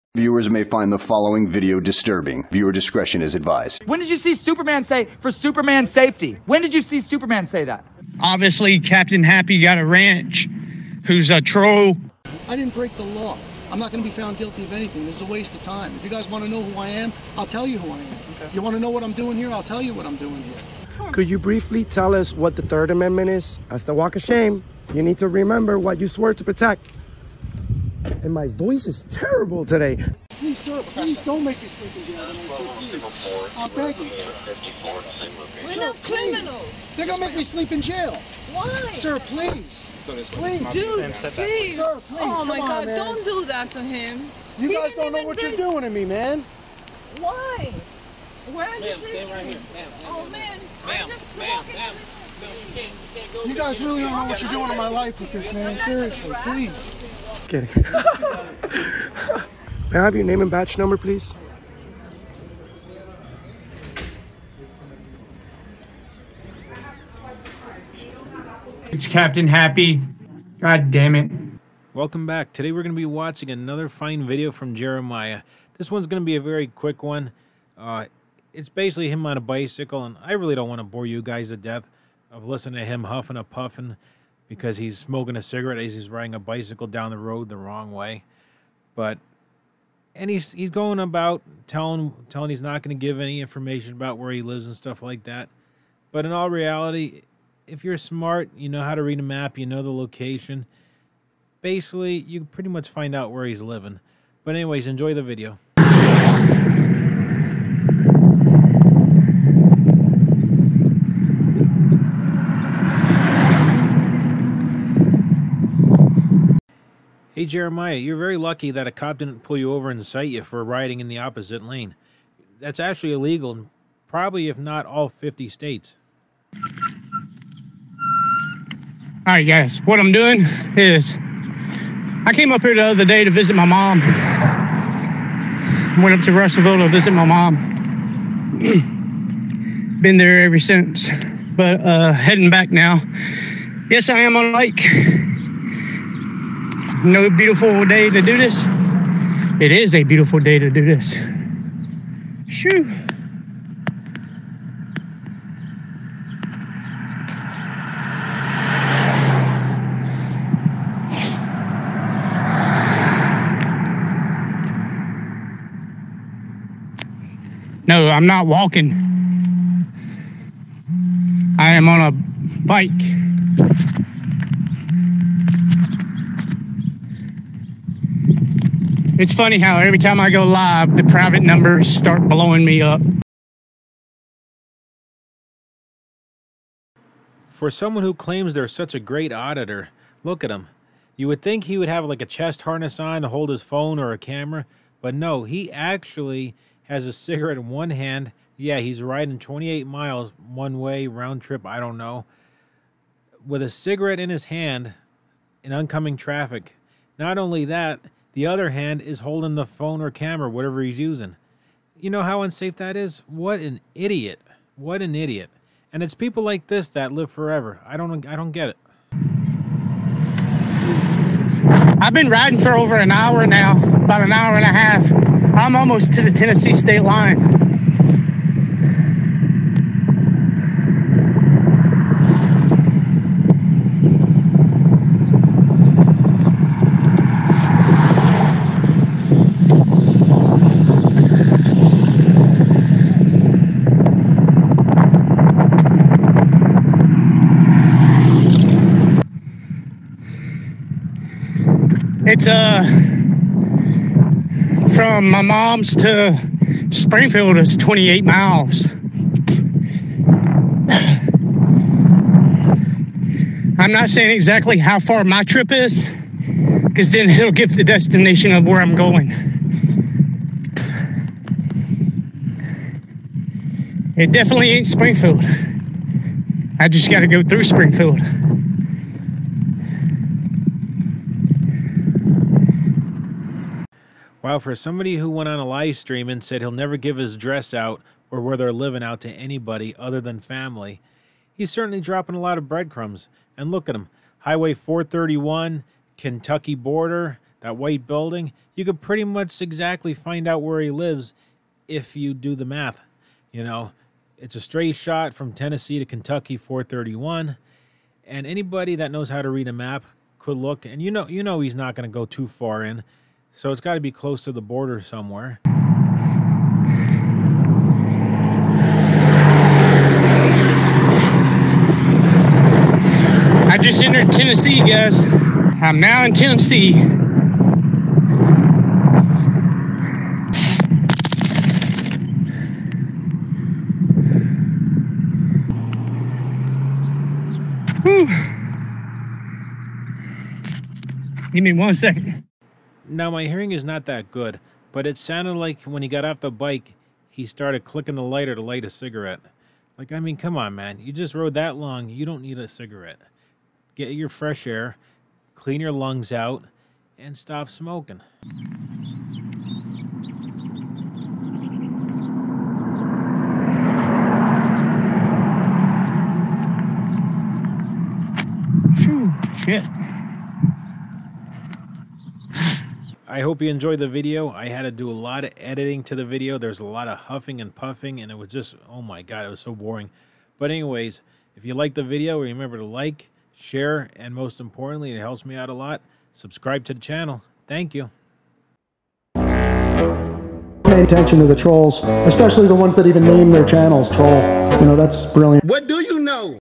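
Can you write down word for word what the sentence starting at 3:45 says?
I'm almost to the Tennessee state line.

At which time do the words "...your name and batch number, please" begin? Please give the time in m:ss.
1:00.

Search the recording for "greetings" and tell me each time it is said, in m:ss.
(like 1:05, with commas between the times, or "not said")
not said.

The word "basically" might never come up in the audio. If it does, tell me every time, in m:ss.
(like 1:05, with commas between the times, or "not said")
1:18, 1:41.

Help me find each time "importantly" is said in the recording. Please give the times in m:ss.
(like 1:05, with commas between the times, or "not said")
6:24.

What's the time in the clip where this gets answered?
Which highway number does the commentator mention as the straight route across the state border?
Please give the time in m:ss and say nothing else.
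4:54.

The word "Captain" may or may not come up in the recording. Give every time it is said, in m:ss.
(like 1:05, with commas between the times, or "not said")
0:08, 1:09.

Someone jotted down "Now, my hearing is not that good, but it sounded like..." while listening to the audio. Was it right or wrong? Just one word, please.
right.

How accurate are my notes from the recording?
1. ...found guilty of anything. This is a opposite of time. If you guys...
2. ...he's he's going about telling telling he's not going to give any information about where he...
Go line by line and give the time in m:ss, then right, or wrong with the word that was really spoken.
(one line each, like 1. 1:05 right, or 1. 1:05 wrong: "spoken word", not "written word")
1. 0:14 wrong: "waste", not "opposite"
2. 1:30 right.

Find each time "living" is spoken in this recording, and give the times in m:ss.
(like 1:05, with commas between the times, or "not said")
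1:43, 4:48.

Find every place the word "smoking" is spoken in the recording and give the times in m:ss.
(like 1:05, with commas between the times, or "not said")
1:24, 5:57.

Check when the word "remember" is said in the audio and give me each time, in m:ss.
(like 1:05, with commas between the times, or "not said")
0:25, 6:22.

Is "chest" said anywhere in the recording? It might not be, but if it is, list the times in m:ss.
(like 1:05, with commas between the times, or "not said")
3:12.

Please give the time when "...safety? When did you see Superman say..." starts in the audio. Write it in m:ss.
0:05.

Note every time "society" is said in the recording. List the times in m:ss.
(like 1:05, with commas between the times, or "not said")
not said.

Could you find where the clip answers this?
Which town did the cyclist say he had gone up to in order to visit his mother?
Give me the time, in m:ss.
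2:16.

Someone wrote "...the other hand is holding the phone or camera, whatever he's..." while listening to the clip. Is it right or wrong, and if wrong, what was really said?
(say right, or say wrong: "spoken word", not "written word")
right.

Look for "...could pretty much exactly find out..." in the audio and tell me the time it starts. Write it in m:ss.
4:58.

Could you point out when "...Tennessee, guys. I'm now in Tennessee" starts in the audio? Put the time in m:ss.
5:24.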